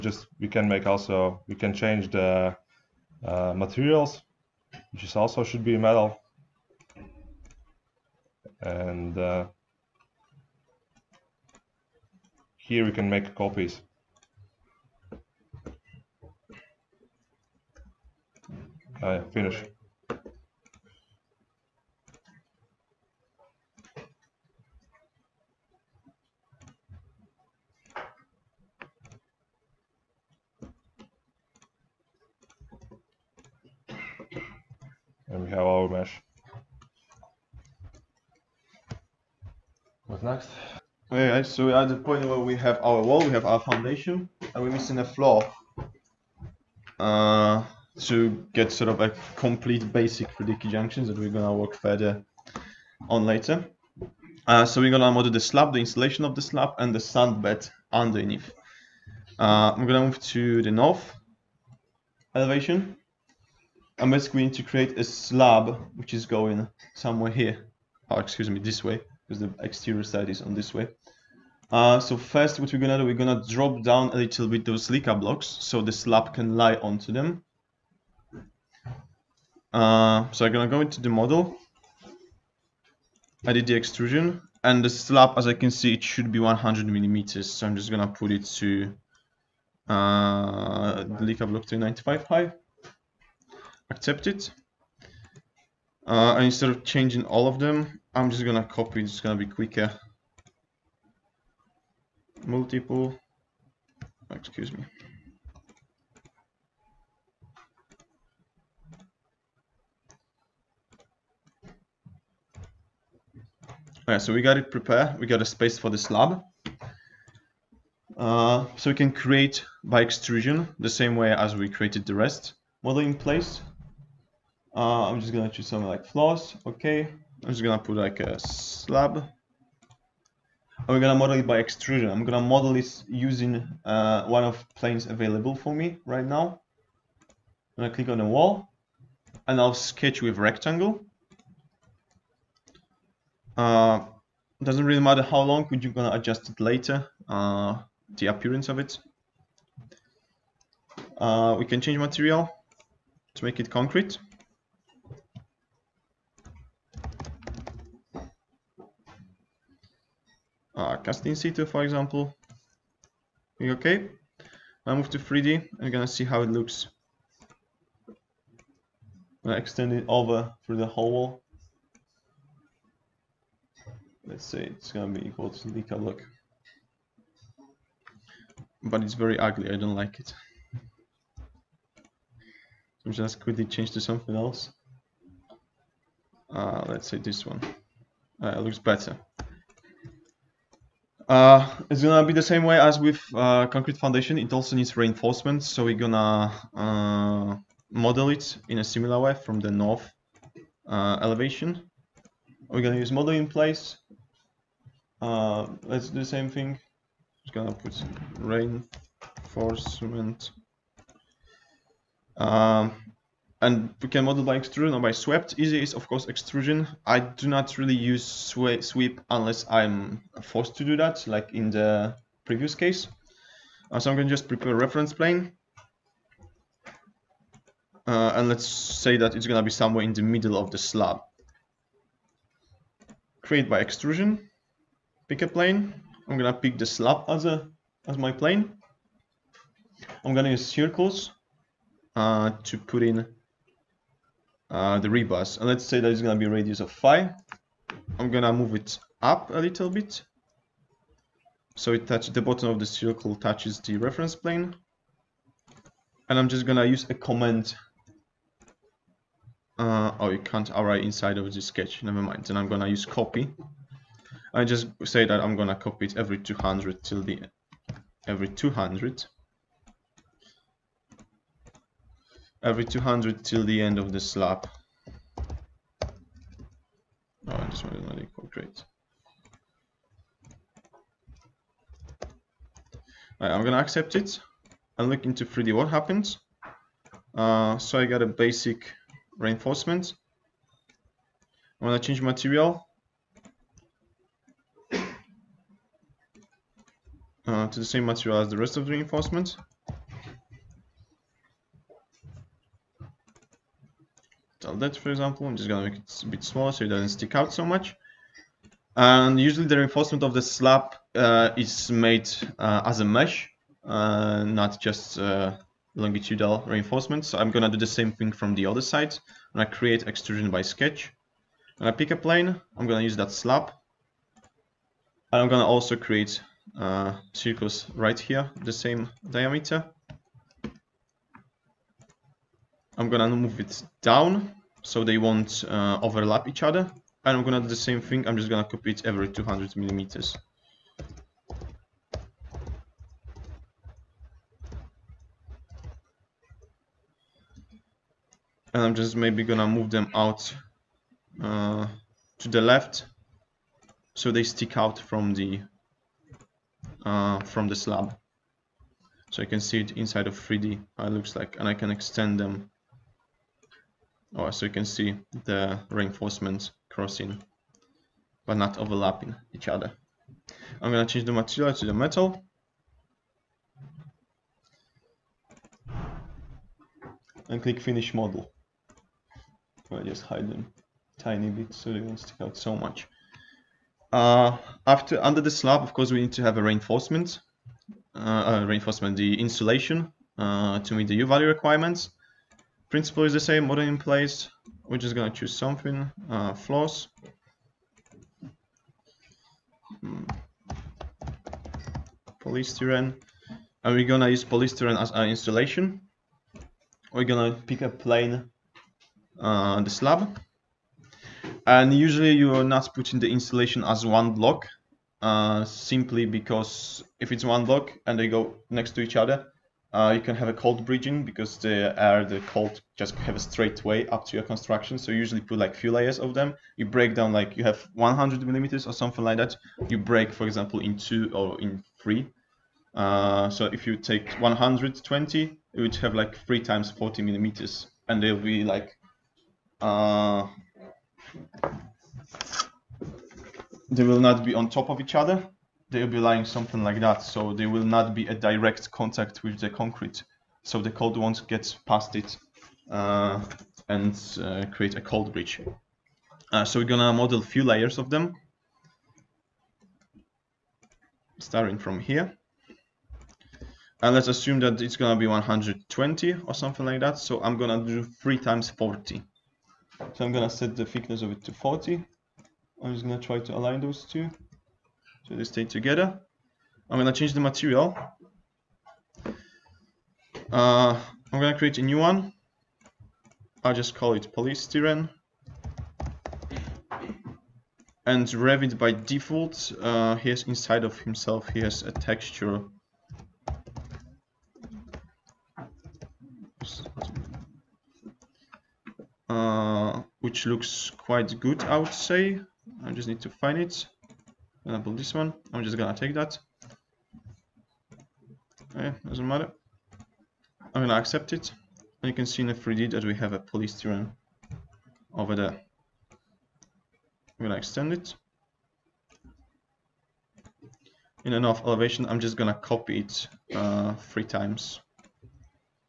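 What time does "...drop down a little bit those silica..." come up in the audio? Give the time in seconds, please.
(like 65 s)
73 s.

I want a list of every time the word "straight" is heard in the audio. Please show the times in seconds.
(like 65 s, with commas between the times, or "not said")
423 s.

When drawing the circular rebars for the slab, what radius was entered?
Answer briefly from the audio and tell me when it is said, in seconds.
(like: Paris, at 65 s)
5, at 246 s.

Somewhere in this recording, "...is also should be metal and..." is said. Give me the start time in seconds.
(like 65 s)
5 s.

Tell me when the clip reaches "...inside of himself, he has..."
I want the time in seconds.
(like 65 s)
490 s.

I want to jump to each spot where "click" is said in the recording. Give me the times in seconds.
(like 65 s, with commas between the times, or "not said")
137 s, 163 s, 377 s.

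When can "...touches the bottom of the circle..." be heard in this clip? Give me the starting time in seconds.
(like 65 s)
252 s.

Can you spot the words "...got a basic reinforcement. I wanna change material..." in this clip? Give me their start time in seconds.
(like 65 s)
288 s.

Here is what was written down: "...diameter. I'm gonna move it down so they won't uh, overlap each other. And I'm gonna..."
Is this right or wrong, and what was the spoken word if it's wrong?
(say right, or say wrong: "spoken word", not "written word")
right.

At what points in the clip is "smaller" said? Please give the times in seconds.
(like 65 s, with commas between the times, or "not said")
306 s.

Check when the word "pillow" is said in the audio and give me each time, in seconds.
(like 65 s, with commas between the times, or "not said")
not said.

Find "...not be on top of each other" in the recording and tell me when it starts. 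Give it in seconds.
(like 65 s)
444 s.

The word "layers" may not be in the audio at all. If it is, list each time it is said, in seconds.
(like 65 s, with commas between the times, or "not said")
425 s, 457 s.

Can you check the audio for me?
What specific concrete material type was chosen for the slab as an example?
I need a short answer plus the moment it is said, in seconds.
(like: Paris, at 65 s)
Cast in situ, at 160 s.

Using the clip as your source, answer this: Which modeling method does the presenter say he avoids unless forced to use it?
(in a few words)
Sweep.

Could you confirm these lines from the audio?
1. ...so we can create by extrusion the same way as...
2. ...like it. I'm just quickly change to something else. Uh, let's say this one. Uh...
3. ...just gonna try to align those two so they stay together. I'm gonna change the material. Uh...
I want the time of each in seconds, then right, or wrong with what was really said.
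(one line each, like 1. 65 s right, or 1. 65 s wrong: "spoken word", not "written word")
1. 118 s right
2. 179 s right
3. 472 s right.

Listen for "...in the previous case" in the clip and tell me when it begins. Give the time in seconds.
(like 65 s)
221 s.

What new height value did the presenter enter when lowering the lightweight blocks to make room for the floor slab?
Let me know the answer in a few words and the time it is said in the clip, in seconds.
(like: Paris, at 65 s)
95, at 91 s.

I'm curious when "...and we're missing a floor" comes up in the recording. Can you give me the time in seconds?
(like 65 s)
44 s.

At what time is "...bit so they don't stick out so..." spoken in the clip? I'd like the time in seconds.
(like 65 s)
381 s.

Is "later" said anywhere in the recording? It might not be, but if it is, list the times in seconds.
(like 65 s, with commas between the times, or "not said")
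53 s, 146 s.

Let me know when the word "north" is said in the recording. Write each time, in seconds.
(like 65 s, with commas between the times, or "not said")
60 s, 199 s.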